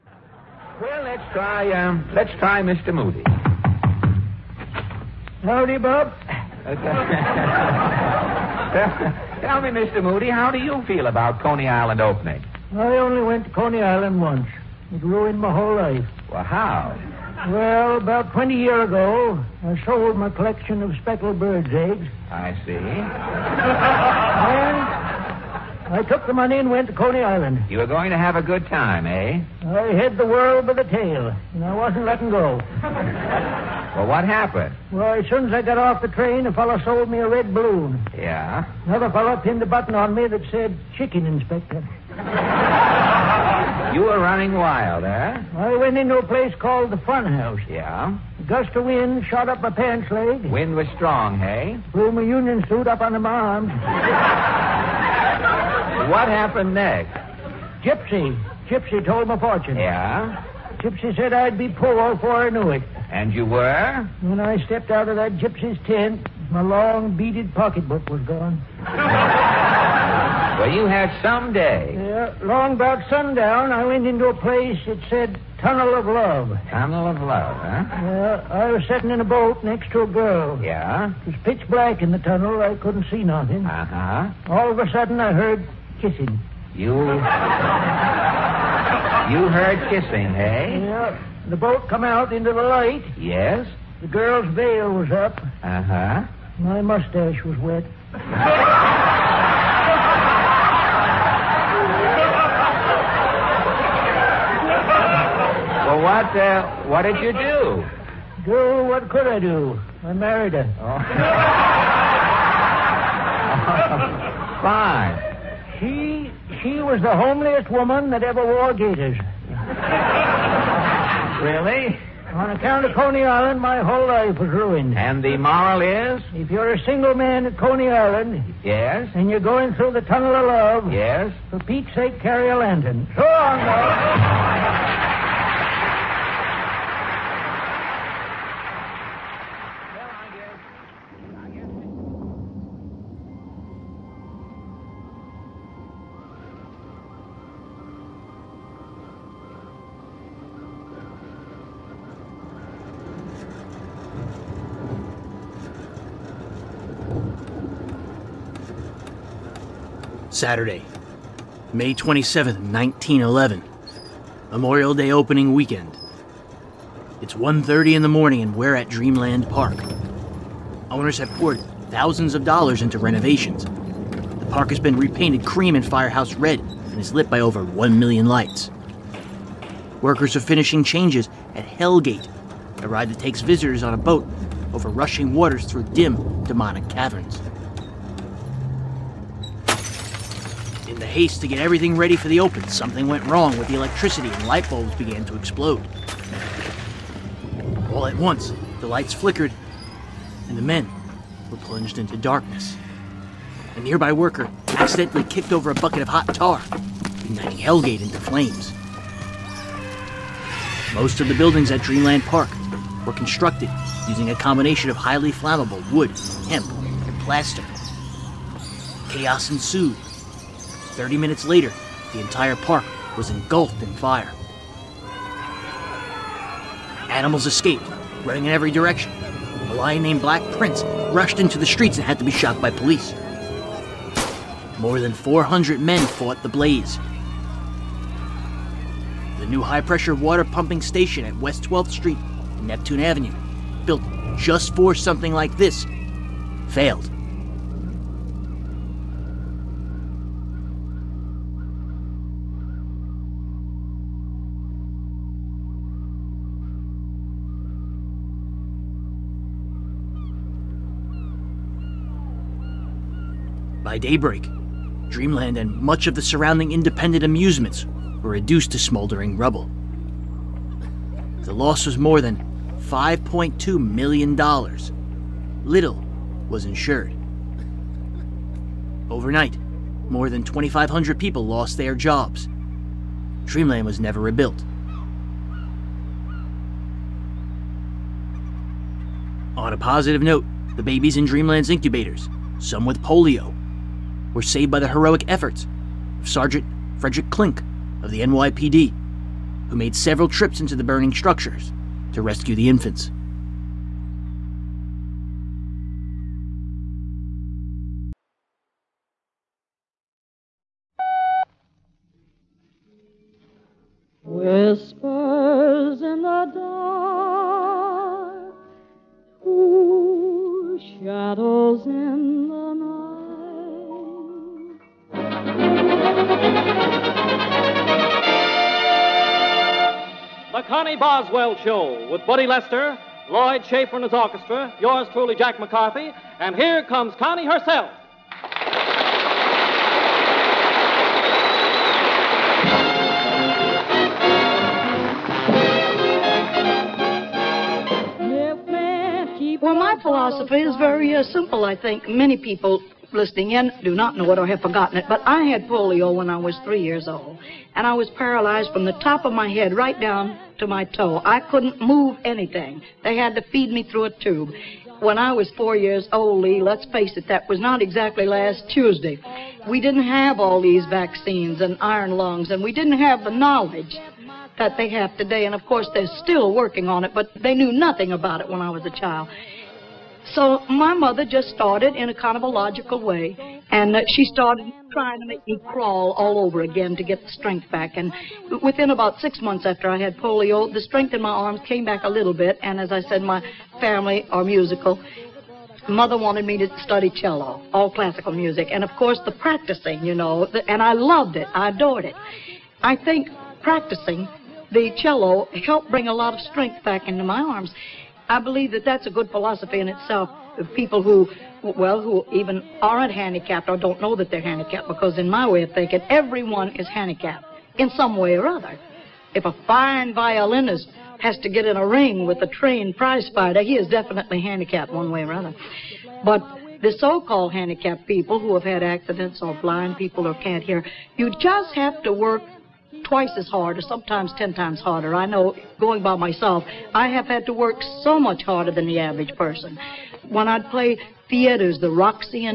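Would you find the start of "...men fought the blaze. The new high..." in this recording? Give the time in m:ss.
3:55.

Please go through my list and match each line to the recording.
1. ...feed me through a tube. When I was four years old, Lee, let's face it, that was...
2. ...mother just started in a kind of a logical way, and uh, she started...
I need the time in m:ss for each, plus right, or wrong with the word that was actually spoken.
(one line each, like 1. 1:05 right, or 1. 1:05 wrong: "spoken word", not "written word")
1. 6:03 right
2. 6:20 right.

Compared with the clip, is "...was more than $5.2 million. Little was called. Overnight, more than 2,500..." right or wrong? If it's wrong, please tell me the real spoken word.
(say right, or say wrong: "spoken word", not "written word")
wrong: "insured", not "called".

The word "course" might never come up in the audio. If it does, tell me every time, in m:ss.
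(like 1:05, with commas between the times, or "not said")
6:15, 6:38.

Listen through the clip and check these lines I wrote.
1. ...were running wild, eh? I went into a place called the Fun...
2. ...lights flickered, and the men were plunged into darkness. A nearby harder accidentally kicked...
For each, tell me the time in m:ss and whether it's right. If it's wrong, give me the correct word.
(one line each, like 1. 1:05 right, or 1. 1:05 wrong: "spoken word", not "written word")
1. 0:44 right
2. 3:18 wrong: "worker", not "harder".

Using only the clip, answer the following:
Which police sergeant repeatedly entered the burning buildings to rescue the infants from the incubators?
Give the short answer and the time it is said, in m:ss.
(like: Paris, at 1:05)
Frederick Klink, at 4:56.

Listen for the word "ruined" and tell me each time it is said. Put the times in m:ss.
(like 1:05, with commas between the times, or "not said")
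0:15, 2:04.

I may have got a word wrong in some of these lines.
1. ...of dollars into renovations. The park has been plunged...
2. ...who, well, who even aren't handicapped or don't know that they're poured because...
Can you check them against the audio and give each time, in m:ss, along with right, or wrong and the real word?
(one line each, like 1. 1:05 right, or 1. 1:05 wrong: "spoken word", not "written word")
1. 2:52 wrong: "repainted", not "plunged"
2. 6:51 wrong: "handicapped", not "poured".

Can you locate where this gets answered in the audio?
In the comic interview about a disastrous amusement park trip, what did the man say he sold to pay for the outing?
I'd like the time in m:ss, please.
0:21.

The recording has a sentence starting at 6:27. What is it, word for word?
And within about six months after I had polio, the strength in my arms came back a little bit.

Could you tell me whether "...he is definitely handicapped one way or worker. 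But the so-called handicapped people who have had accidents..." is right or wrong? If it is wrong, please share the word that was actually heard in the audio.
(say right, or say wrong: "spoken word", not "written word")
wrong: "another", not "worker".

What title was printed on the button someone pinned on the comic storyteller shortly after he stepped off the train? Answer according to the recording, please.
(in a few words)
Chicken Inspector.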